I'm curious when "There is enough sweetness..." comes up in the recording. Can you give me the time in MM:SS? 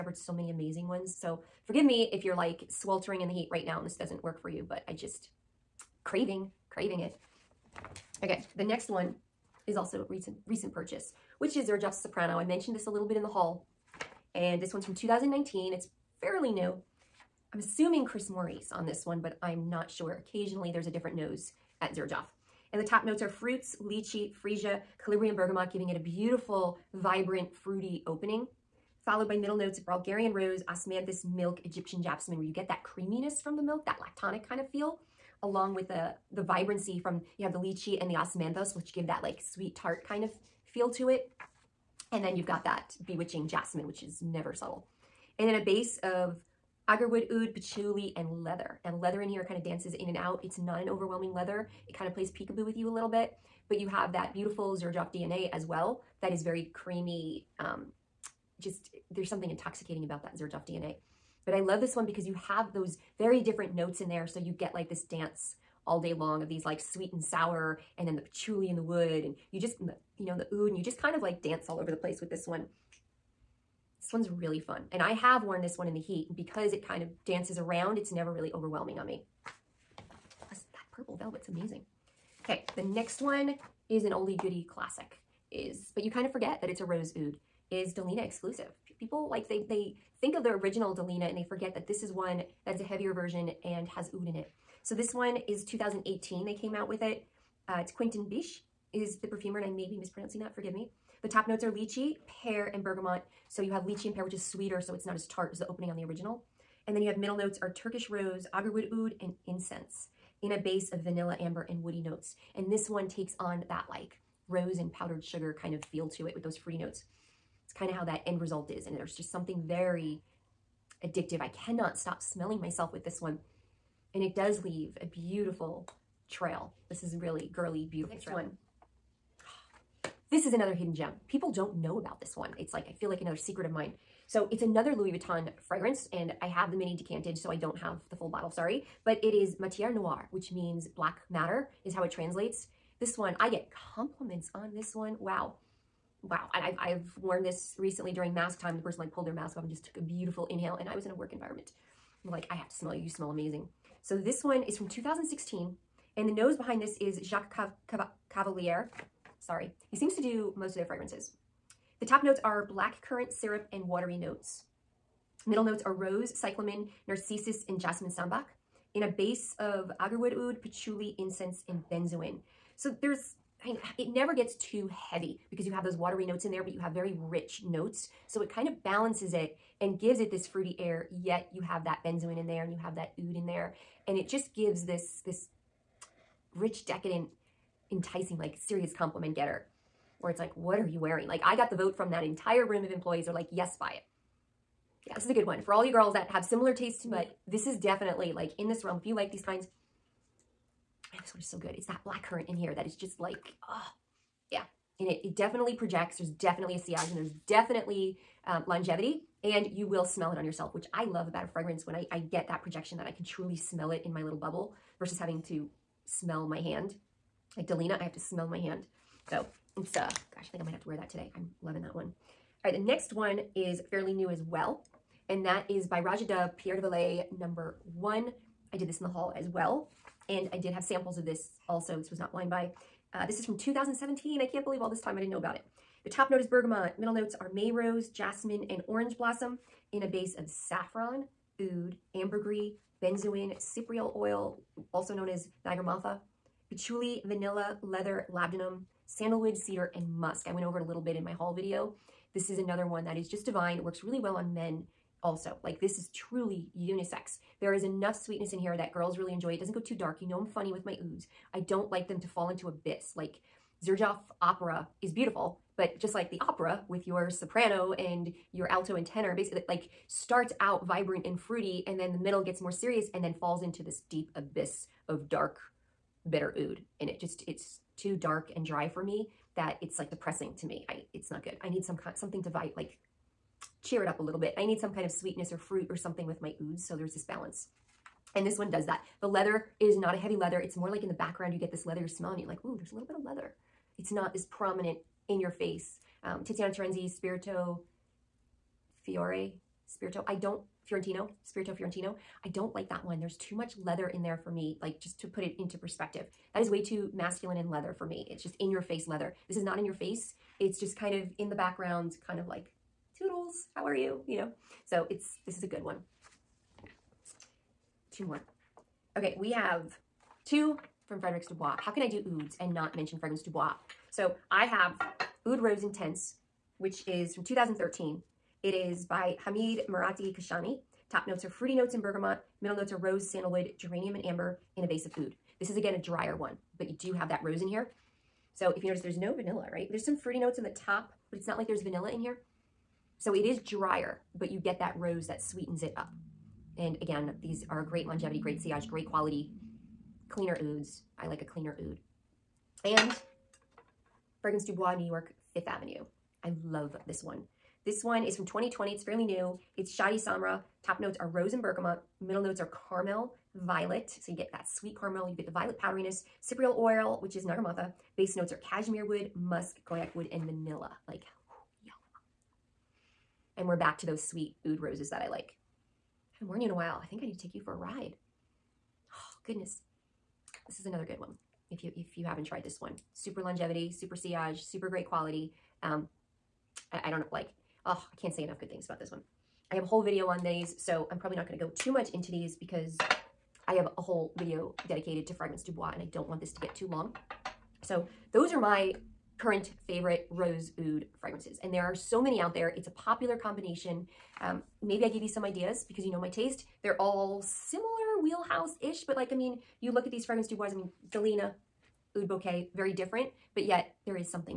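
04:17.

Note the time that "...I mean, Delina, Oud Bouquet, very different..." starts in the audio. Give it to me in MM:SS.
06:50.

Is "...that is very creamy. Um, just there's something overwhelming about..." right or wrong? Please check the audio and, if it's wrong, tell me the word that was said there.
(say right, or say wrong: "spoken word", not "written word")
wrong: "intoxicating", not "overwhelming".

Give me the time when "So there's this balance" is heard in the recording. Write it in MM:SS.
04:46.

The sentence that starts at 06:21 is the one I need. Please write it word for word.
If you, if you haven't tried this one, super longevity, super sillage, super great quality.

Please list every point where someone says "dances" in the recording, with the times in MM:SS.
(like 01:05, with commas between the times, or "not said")
00:49, 01:05, 01:11, 01:17.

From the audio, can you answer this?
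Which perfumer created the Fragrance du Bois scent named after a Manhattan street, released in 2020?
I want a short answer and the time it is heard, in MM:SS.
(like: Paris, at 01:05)
Shadi Samra, at 05:59.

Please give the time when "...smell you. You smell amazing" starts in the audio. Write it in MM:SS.
02:32.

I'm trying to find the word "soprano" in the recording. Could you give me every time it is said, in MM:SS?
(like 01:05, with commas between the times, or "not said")
00:11, 04:27.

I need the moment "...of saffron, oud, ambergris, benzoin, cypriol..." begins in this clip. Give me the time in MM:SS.
04:00.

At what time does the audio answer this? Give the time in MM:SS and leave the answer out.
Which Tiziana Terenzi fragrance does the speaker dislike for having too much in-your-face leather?
05:01.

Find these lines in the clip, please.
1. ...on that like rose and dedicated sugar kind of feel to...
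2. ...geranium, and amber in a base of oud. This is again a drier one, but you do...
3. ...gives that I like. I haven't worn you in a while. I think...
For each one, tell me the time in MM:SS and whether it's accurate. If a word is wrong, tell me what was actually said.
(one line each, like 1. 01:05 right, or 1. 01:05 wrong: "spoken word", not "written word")
1. 01:53 wrong: "powdered", not "dedicated"
2. 05:33 right
3. 06:14 wrong: "roses", not "gives".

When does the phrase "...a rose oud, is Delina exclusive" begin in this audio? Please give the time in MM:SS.
01:26.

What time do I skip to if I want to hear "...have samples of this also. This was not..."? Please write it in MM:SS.
03:50.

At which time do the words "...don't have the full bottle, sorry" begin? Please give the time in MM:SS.
02:17.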